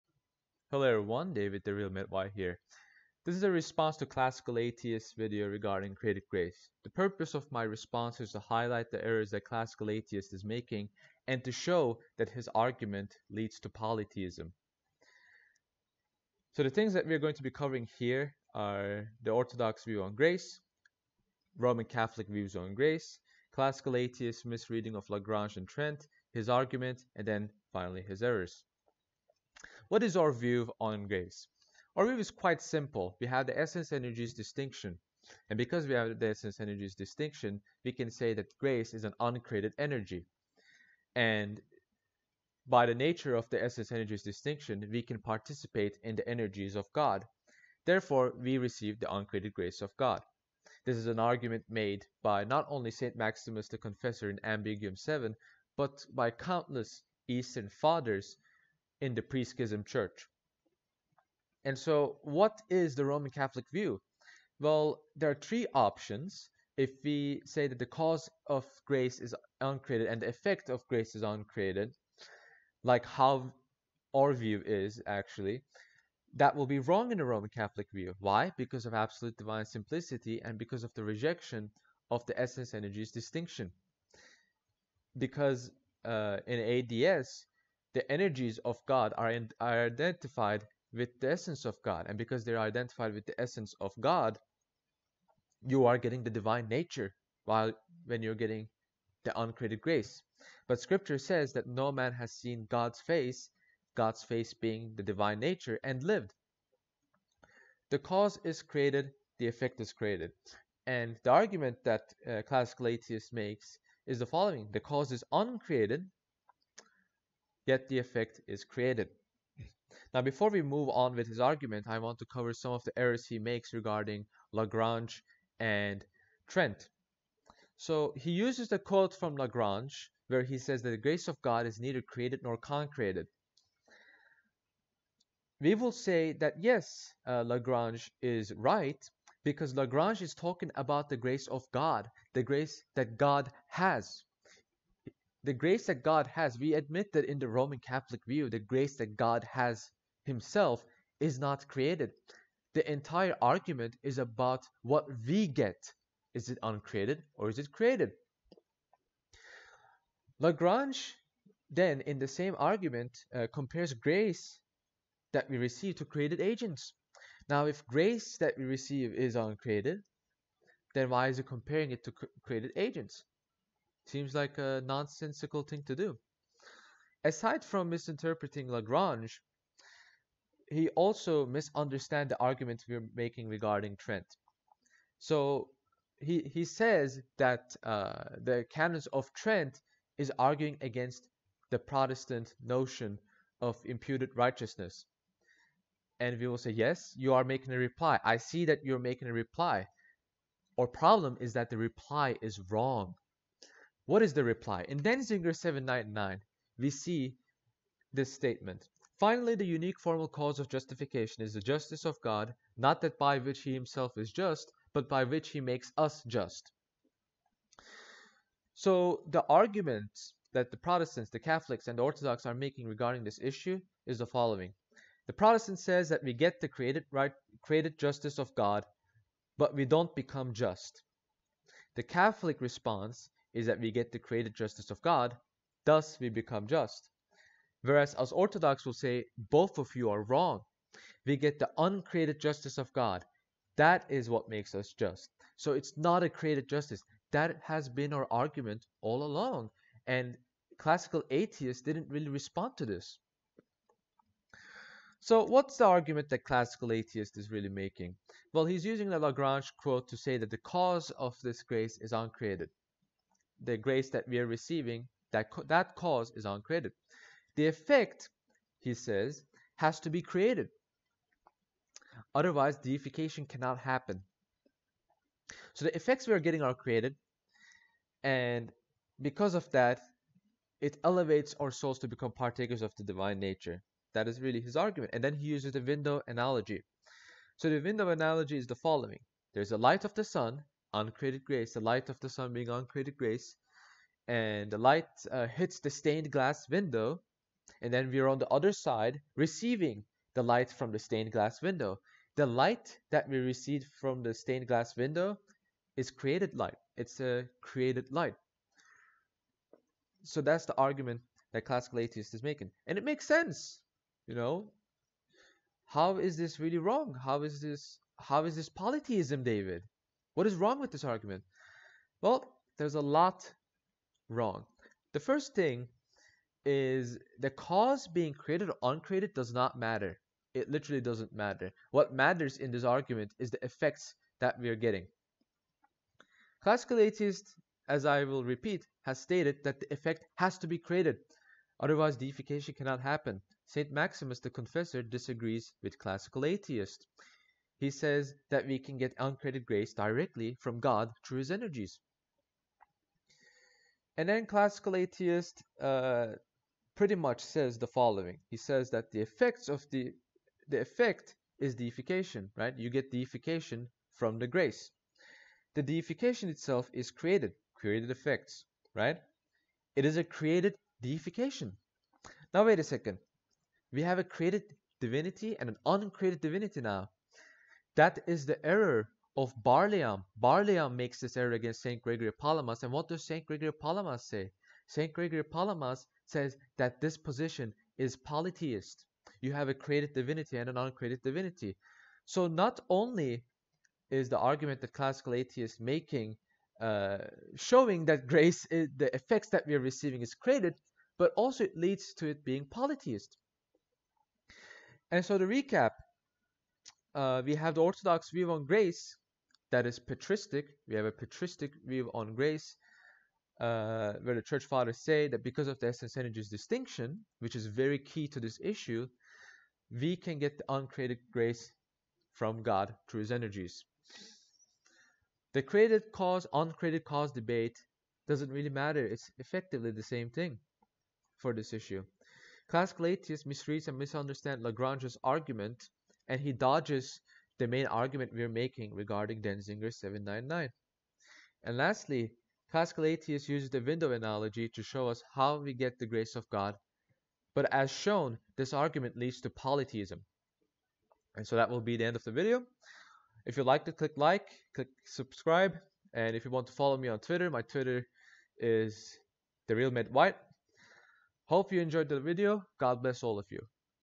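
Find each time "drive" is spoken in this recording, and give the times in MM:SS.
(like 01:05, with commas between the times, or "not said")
not said.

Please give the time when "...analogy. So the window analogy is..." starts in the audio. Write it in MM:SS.
04:46.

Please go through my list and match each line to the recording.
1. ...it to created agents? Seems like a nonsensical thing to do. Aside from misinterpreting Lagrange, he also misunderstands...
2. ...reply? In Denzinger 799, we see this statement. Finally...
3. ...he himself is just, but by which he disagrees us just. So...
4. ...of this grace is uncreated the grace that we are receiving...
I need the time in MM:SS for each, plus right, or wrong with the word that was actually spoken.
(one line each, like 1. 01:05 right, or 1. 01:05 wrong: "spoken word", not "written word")
1. 02:51 right
2. 03:24 right
3. 03:33 wrong: "makes", not "disagrees"
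4. 04:21 right.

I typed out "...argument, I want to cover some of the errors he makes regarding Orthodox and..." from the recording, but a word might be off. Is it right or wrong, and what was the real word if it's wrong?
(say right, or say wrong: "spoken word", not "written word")
wrong: "Lagrange", not "Orthodox".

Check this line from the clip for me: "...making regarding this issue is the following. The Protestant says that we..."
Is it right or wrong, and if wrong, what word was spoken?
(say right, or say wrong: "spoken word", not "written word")
right.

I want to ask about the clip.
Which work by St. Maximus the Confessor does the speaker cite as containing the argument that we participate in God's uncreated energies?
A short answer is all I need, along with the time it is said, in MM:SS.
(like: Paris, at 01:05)
Ambiguum 7, at 00:54.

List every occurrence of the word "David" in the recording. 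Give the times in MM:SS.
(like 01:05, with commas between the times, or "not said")
00:01, 05:19.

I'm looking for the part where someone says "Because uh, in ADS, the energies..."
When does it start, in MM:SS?
01:25.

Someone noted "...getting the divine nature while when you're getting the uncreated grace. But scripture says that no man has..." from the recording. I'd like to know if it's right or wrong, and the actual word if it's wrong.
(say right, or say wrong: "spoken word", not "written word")
right.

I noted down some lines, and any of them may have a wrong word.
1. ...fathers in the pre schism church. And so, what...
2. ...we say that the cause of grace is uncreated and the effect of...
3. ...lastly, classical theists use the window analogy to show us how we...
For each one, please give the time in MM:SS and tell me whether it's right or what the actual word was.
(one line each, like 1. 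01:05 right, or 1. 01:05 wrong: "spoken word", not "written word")
1. 00:57 right
2. 01:07 right
3. 07:21 right.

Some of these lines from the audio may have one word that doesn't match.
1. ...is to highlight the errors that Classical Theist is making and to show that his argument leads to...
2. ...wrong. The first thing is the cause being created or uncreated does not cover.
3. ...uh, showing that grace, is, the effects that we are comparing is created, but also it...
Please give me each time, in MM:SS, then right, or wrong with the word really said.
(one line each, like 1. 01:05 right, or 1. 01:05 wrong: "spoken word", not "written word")
1. 00:08 right
2. 05:24 wrong: "matter", not "cover"
3. 06:36 wrong: "receiving", not "comparing".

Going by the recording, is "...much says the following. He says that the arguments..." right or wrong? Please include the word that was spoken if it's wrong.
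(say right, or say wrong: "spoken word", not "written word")
wrong: "effects", not "arguments".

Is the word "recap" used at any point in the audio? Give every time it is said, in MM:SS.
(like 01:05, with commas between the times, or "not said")
06:45.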